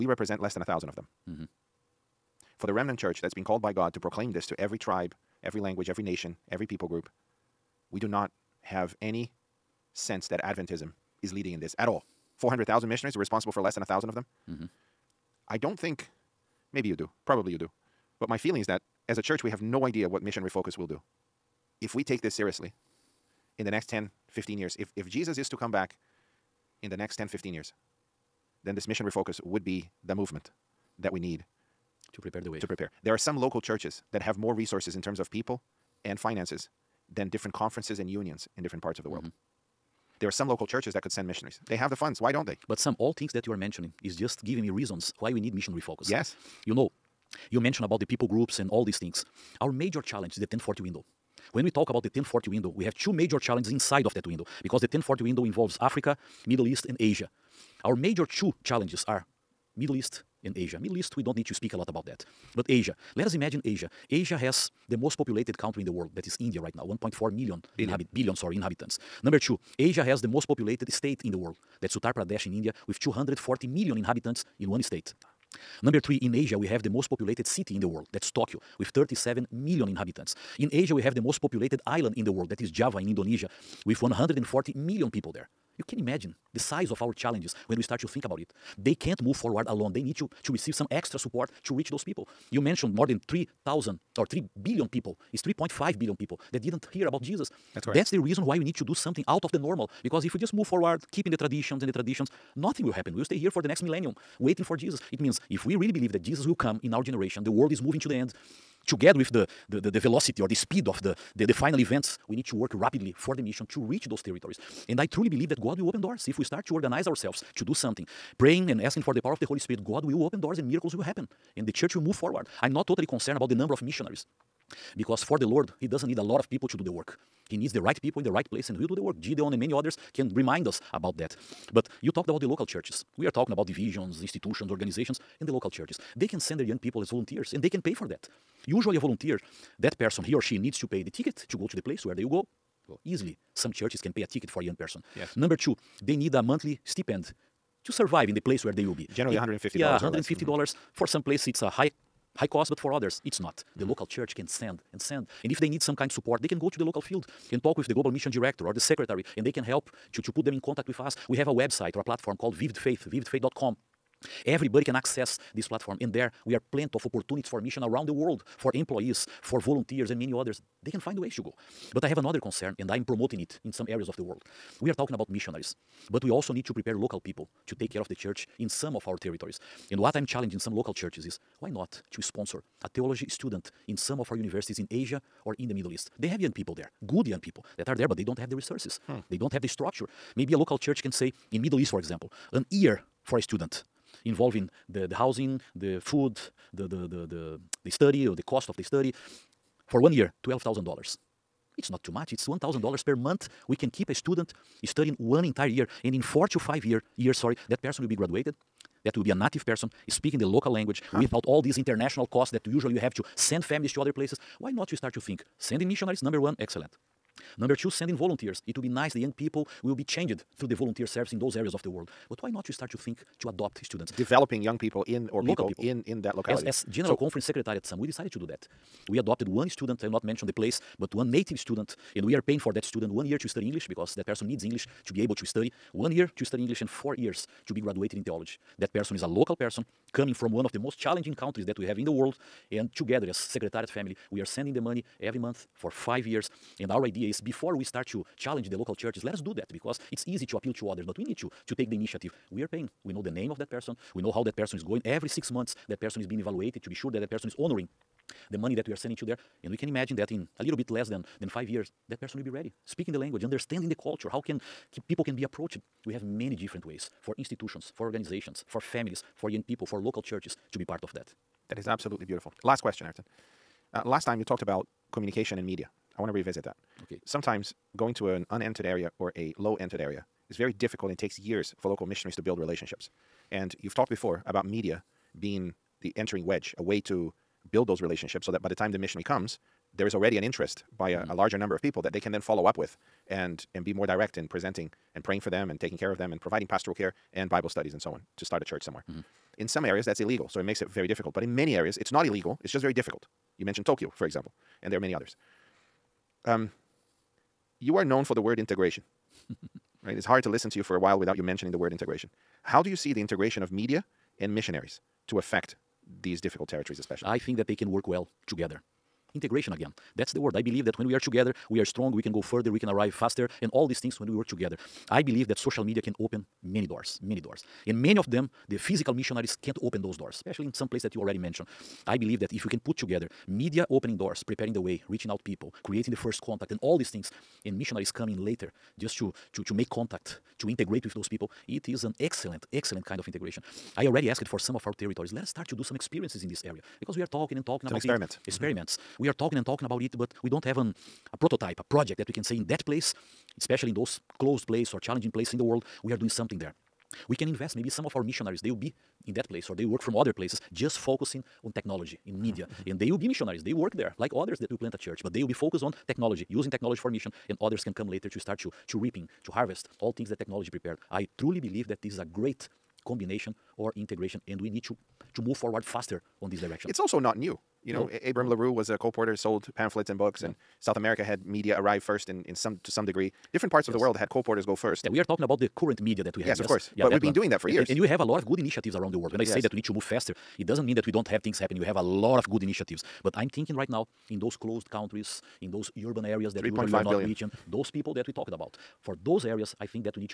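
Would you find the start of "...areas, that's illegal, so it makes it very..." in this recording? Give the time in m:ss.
4:59.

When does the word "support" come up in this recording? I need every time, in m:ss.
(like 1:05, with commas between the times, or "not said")
1:31, 2:36.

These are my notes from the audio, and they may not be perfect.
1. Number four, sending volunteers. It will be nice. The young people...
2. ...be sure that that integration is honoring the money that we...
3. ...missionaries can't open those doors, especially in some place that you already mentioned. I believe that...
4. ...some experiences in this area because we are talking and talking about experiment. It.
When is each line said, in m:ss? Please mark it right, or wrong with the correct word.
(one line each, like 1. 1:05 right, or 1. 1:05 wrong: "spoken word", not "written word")
1. 3:37 wrong: "two", not "four"
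2. 4:16 wrong: "person", not "integration"
3. 5:29 right
4. 5:45 right.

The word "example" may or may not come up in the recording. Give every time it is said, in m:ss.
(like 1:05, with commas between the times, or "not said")
3:11, 5:04.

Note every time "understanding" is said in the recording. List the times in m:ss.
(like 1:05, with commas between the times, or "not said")
4:23.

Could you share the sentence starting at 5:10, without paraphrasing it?
It's hard to listen to you for a while without you mentioning the word integration.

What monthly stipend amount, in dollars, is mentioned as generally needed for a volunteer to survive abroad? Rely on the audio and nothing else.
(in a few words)
$150.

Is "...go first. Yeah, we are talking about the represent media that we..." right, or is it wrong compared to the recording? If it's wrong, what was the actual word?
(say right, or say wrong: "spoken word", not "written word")
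wrong: "current", not "represent".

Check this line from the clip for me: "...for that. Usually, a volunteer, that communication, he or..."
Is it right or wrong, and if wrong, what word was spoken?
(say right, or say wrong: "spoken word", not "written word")
wrong: "person", not "communication".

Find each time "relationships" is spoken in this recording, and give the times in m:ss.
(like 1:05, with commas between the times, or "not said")
4:42, 4:48.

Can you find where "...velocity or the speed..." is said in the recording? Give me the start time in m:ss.
1:49.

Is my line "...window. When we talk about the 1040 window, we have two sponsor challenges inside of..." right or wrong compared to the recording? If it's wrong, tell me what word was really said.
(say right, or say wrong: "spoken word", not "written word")
wrong: "major", not "sponsor".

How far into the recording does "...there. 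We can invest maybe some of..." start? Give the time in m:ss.
5:56.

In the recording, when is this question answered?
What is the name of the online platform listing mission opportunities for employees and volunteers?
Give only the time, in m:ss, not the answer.
2:42.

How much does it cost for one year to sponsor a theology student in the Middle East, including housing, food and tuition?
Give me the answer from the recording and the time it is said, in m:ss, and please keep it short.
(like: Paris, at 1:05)
$12,000, at 3:20.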